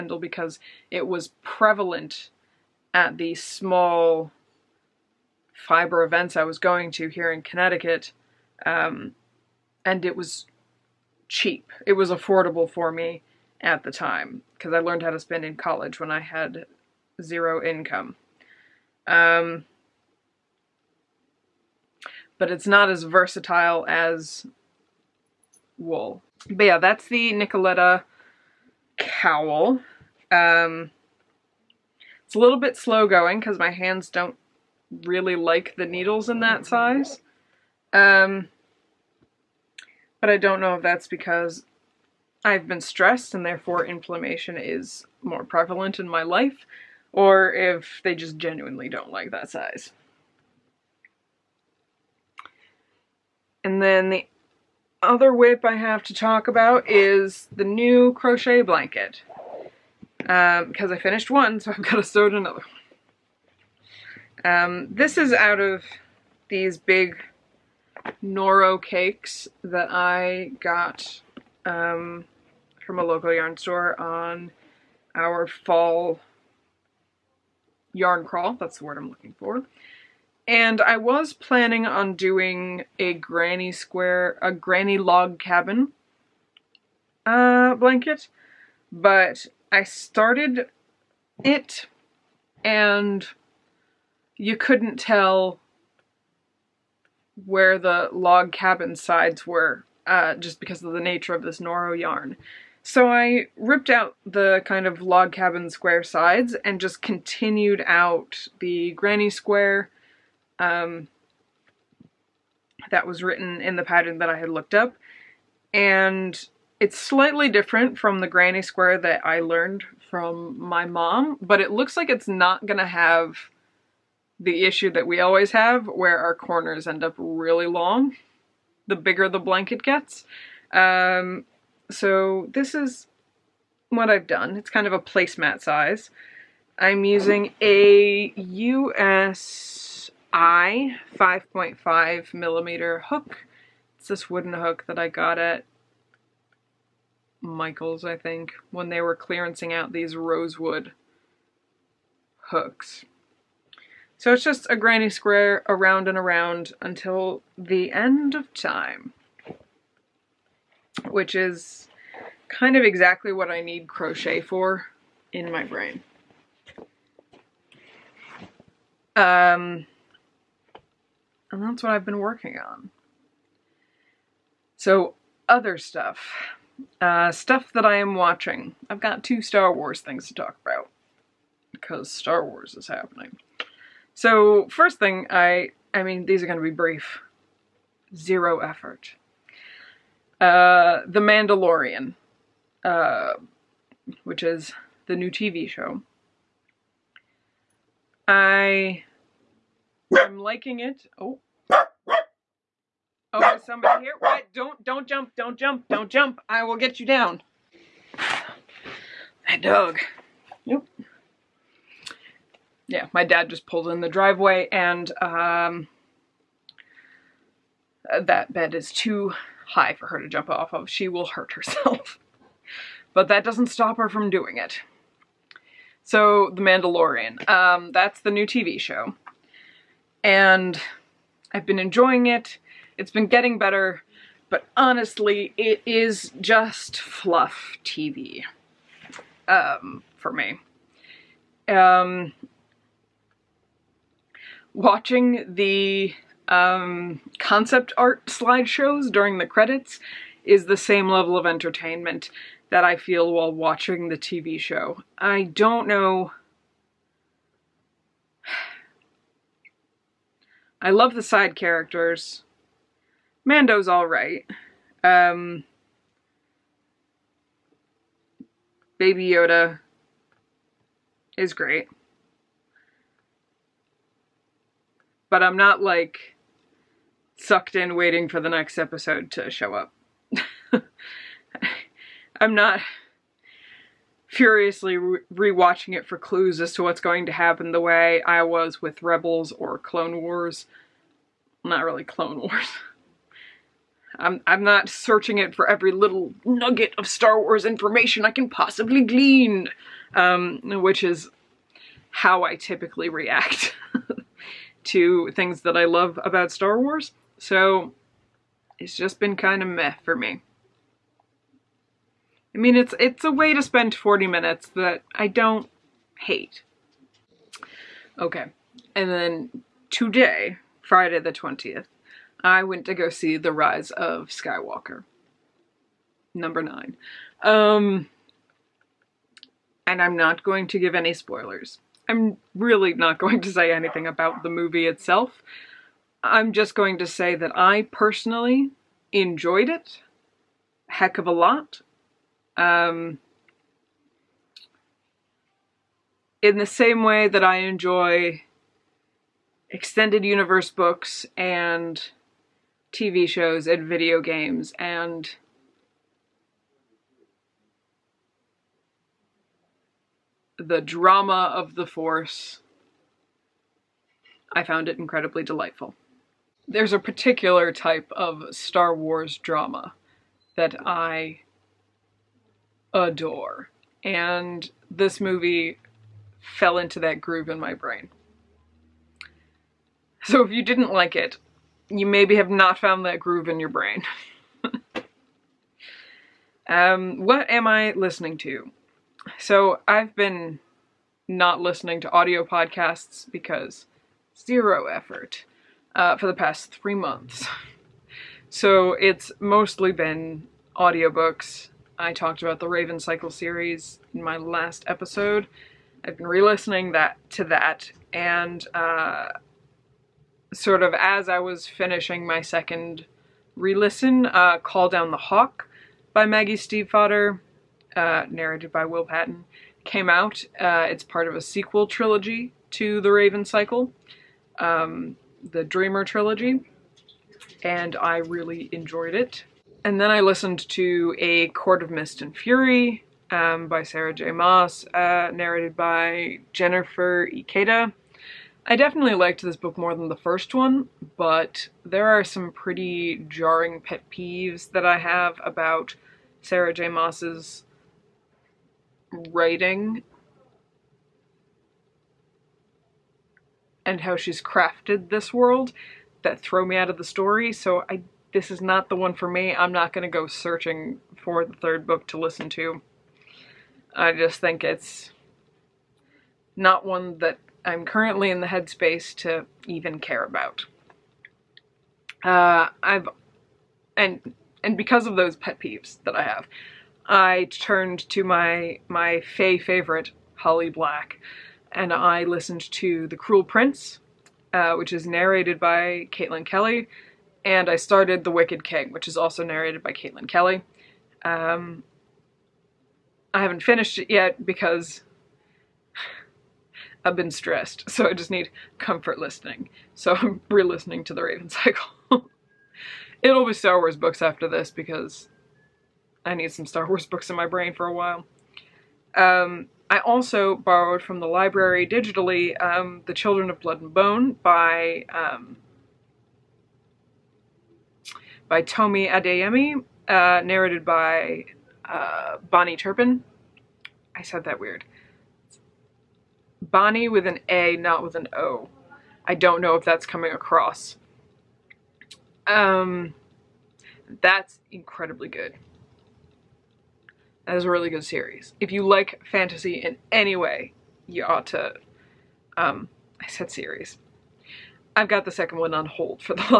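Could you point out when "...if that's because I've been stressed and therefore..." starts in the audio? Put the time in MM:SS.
00:40.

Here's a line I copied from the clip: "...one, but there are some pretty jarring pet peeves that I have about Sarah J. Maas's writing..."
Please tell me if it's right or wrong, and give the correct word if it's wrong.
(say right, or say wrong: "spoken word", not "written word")
right.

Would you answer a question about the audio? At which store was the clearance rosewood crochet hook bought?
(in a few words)
Michael's.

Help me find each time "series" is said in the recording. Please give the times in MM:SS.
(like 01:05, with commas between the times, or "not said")
06:43, 08:58, 09:03.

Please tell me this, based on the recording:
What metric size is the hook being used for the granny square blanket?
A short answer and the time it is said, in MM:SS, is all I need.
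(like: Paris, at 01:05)
5.5 millimeter, at 02:21.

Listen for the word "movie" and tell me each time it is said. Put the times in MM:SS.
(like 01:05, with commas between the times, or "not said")
05:34, 06:15.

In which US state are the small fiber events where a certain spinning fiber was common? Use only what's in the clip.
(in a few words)
Connecticut.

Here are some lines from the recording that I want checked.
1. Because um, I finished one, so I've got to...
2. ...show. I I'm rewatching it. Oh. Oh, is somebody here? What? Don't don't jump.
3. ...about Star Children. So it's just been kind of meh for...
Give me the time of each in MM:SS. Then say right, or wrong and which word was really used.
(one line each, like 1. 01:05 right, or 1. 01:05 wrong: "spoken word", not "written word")
1. 01:00 right
2. 03:15 wrong: "liking", not "rewatching"
3. 05:06 wrong: "Wars", not "Children".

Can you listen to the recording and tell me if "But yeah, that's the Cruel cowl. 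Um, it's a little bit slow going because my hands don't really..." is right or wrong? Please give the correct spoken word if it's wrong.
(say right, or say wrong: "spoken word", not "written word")
wrong: "Nicoletta", not "Cruel".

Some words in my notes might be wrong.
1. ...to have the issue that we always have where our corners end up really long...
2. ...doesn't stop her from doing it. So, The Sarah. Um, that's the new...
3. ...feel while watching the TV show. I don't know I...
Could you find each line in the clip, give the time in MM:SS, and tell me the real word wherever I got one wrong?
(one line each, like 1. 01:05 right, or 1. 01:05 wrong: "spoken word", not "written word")
1. 02:02 right
2. 03:43 wrong: "Mandalorian", not "Sarah"
3. 04:12 right.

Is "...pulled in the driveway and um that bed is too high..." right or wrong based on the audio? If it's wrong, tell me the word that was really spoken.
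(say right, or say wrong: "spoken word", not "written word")
right.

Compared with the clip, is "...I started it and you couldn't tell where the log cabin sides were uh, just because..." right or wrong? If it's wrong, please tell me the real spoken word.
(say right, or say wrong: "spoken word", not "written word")
right.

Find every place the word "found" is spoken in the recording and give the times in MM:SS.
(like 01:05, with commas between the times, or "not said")
06:04, 06:22.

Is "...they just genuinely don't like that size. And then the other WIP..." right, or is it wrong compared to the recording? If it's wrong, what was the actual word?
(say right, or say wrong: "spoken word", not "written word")
right.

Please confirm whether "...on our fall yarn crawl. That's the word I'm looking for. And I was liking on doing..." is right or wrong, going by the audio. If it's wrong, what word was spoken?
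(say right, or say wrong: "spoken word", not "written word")
wrong: "planning", not "liking".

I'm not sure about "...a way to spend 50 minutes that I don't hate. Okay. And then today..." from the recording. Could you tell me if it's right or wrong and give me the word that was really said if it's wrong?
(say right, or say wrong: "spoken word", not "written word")
wrong: "40", not "50".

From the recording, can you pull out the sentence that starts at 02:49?
Um, and that's what I've been working on.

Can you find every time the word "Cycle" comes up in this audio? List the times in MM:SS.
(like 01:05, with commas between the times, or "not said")
06:42, 07:03, 08:21.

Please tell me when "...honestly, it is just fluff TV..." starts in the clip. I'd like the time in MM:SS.
03:54.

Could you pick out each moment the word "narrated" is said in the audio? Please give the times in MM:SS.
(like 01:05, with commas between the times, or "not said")
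06:58, 07:15, 08:05, 08:09, 08:40.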